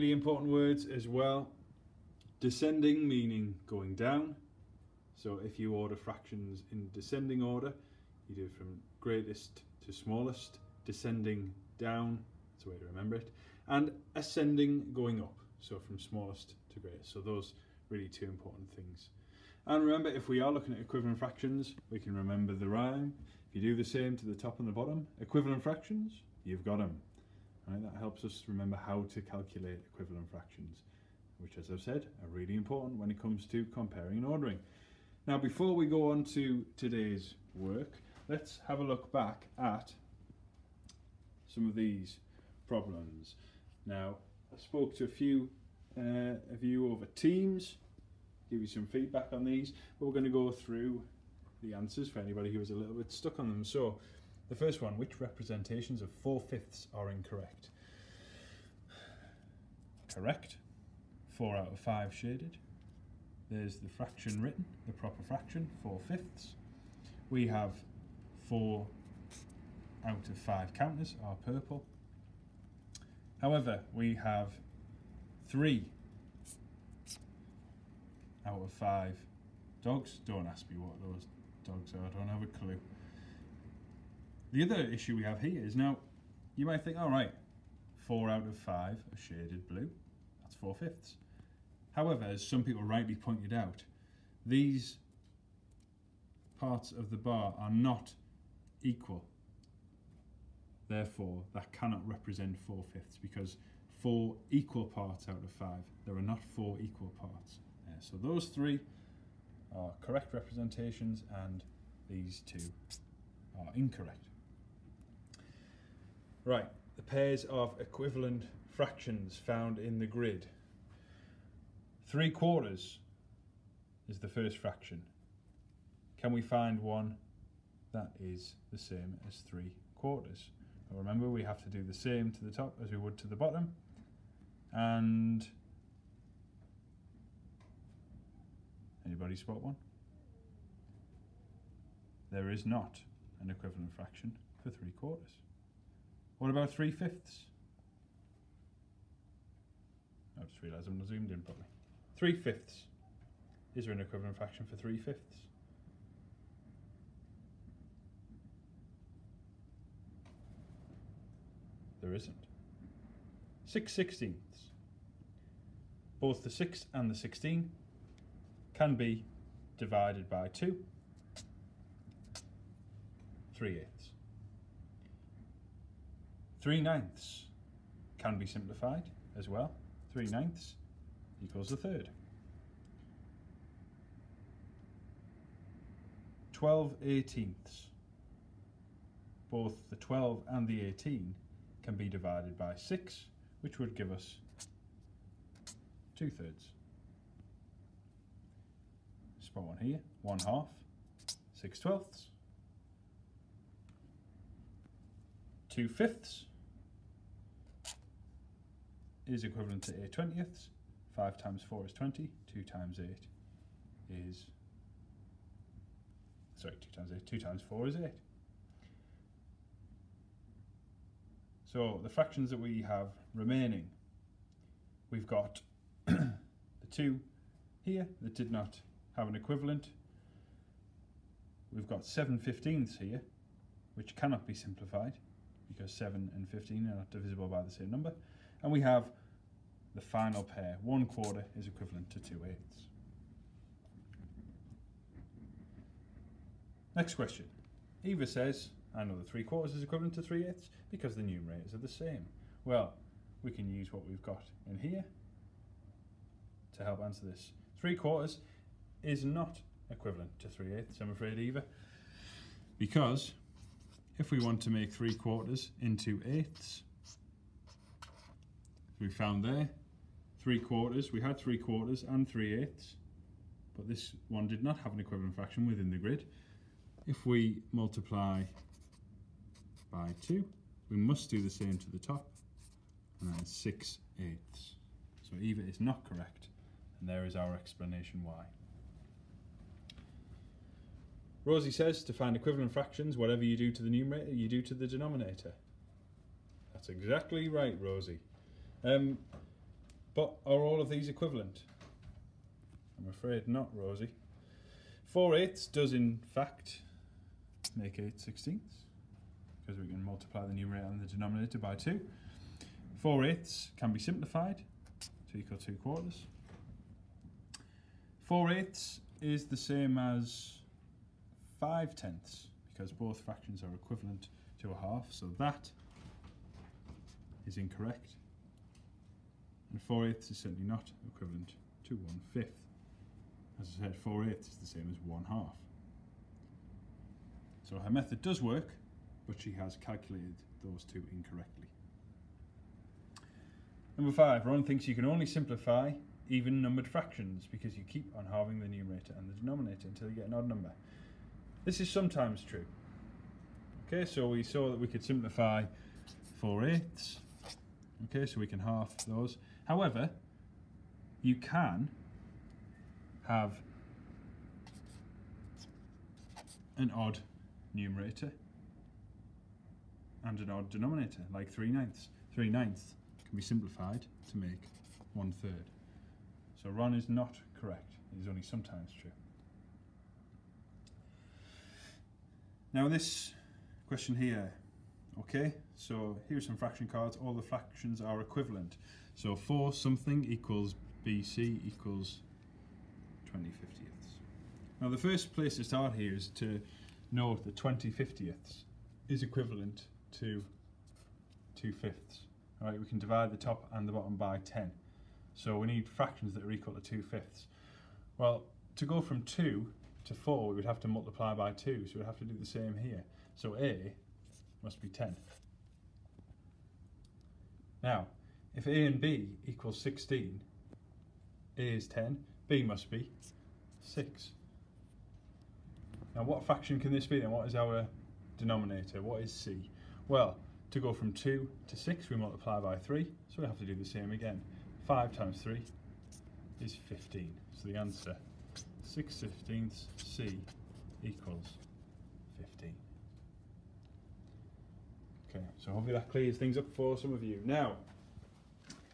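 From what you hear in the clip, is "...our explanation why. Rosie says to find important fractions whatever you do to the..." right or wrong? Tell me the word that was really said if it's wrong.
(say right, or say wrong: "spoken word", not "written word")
wrong: "equivalent", not "important".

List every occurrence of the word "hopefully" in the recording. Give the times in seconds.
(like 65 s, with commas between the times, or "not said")
445 s.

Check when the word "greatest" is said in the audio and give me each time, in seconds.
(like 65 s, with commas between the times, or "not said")
8 s, 16 s.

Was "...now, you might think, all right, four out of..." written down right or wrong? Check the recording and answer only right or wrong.
right.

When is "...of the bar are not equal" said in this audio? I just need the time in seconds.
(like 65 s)
96 s.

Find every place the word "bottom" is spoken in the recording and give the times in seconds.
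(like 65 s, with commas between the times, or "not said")
24 s, 133 s, 403 s.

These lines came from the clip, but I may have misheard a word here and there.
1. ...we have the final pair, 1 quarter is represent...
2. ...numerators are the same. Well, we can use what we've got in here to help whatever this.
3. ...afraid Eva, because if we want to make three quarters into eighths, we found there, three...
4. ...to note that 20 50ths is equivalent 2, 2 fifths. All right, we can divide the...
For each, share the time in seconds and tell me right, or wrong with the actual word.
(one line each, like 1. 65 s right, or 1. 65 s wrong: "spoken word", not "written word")
1. 238 s wrong: "equivalent", not "represent"
2. 251 s wrong: "answer", not "whatever"
3. 261 s right
4. 396 s right.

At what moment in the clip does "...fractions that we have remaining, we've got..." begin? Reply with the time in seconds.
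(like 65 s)
222 s.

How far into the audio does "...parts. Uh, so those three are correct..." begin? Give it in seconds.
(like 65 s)
107 s.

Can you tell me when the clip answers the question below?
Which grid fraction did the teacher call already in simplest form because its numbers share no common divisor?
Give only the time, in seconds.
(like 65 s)
232 s.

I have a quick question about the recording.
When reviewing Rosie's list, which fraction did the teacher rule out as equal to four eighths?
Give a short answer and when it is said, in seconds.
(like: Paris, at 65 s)
1/5, at 331 s.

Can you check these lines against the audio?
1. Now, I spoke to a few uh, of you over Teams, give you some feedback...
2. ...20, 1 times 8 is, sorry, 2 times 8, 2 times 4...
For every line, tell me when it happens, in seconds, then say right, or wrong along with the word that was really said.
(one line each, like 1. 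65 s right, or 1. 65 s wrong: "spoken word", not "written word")
1. 43 s right
2. 211 s wrong: "2", not "1".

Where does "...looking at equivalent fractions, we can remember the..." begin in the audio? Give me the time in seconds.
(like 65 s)
20 s.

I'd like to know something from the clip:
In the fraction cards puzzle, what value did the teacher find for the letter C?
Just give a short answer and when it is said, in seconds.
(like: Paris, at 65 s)
15, at 439 s.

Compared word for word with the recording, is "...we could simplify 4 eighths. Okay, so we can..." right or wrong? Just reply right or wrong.
right.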